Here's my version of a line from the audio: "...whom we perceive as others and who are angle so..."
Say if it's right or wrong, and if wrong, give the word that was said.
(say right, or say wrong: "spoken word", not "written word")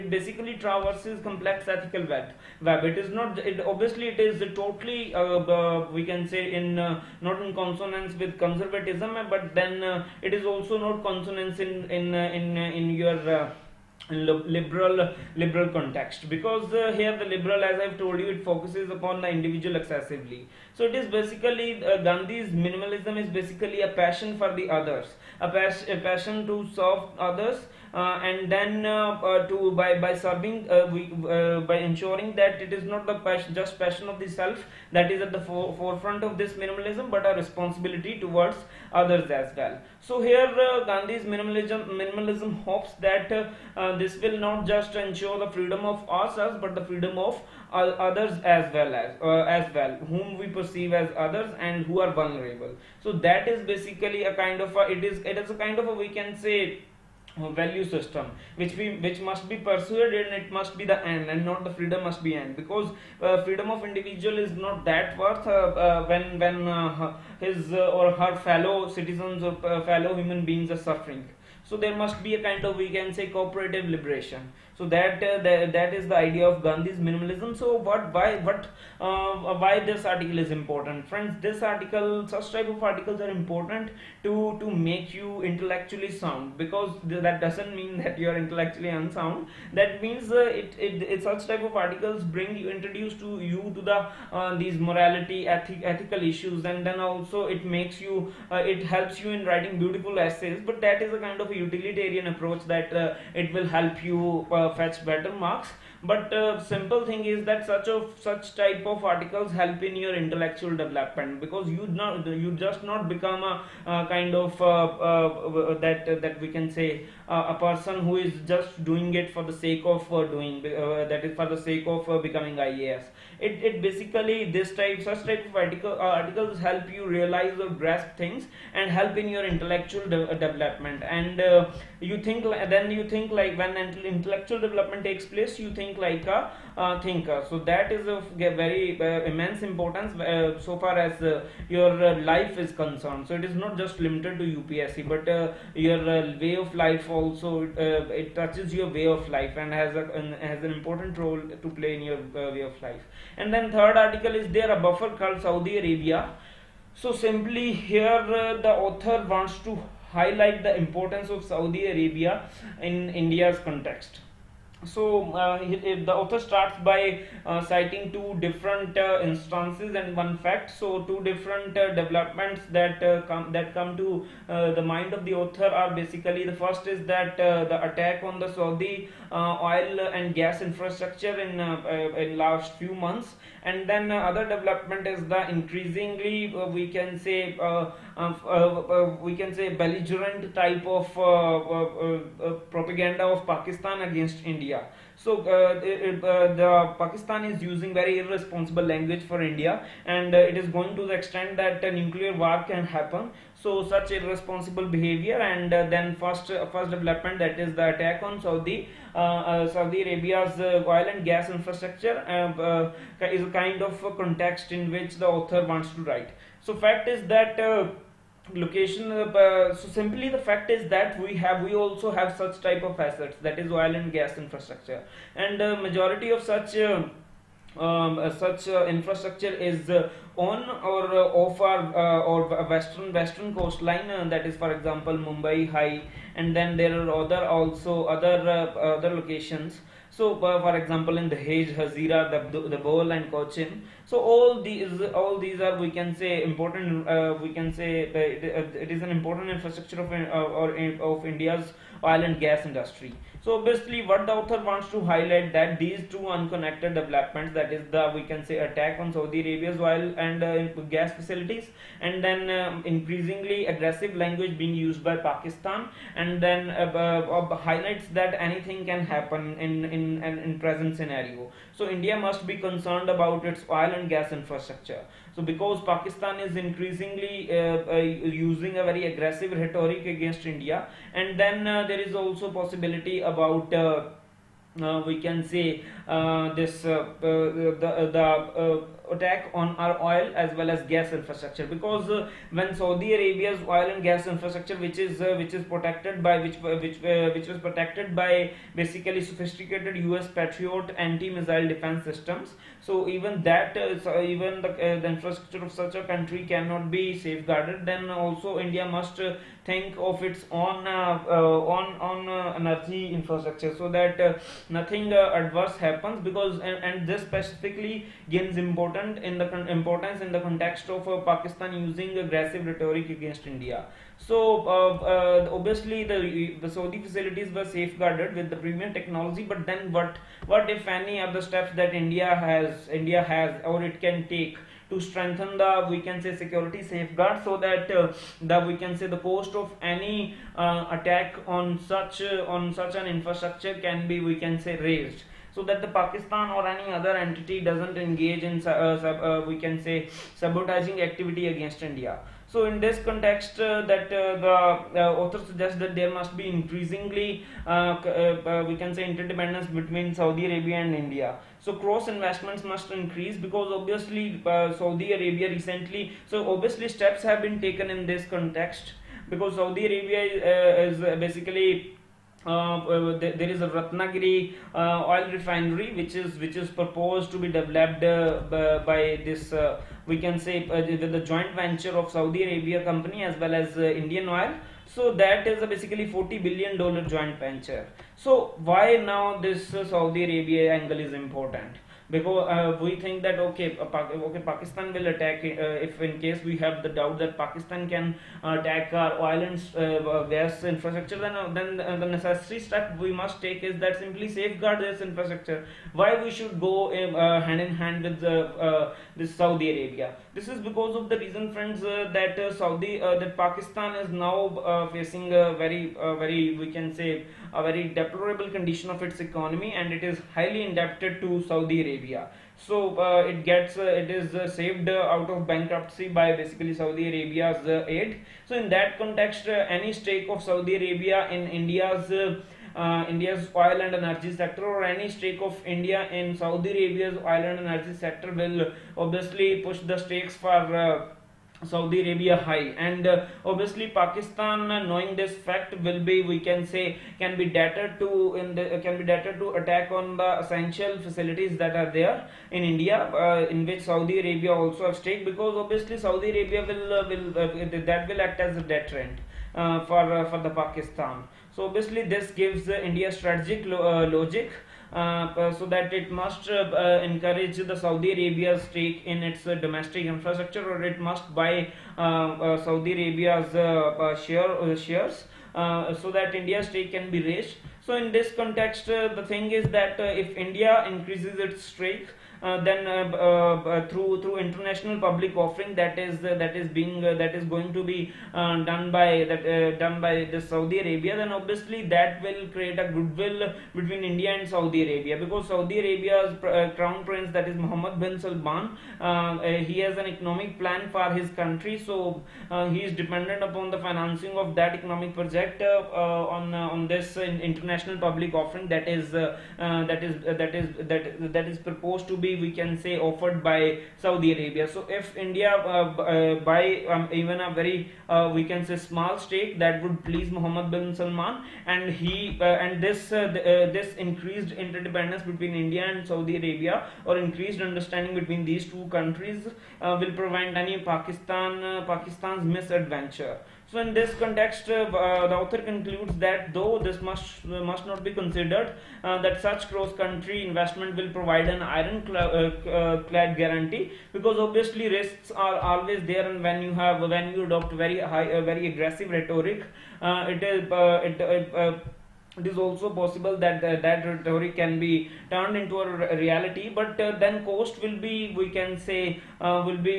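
wrong: "vulnerable", not "angle".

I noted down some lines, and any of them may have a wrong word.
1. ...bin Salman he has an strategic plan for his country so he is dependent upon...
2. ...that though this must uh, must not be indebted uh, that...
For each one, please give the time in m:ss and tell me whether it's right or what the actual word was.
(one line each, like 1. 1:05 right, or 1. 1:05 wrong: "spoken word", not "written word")
1. 8:17 wrong: "economic", not "strategic"
2. 8:56 wrong: "considered", not "indebted".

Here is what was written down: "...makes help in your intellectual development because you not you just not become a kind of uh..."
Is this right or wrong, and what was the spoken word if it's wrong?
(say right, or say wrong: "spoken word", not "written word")
wrong: "articles", not "makes".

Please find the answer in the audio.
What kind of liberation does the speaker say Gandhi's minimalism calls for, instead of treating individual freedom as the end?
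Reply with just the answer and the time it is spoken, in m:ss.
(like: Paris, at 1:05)
cooperative liberation, at 1:13.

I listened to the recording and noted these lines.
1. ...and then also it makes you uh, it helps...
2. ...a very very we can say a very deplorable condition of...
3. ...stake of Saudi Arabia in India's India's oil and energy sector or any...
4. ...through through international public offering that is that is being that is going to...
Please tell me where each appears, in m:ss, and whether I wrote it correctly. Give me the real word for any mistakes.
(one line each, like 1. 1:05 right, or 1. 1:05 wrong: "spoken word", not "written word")
1. 1:36 right
2. 6:55 right
3. 7:09 right
4. 8:03 right.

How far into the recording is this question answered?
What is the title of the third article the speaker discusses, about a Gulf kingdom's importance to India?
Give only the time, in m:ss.
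2:34.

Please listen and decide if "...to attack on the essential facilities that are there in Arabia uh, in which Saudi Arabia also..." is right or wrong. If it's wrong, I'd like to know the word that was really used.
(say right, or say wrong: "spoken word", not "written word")
wrong: "India", not "Arabia".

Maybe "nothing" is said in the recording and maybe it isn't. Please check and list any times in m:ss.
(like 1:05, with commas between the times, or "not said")
5:14.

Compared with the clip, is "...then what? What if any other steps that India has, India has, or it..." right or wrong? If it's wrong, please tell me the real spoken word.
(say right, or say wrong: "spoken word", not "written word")
right.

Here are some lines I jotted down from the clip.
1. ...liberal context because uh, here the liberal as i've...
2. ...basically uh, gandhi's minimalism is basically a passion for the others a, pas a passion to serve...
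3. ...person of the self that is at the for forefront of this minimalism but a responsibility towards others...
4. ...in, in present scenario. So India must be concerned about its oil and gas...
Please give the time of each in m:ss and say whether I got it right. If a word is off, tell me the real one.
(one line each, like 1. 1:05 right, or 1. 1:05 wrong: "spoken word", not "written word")
1. 0:15 right
2. 0:21 right
3. 0:33 wrong: "passion", not "person"
4. 4:29 right.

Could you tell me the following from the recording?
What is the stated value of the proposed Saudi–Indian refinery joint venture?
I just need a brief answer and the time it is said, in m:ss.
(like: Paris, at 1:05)
40 billion dollars, at 6:26.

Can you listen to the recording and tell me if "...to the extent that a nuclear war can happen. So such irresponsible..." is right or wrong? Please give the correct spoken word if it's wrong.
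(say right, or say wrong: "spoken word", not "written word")
right.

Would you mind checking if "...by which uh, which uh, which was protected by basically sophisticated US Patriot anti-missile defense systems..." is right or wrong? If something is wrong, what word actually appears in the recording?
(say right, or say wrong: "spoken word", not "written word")
right.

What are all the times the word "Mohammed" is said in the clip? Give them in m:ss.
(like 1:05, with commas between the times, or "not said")
8:17, 8:40.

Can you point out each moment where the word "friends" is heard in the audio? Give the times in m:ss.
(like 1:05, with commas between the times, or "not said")
1:21, 6:51.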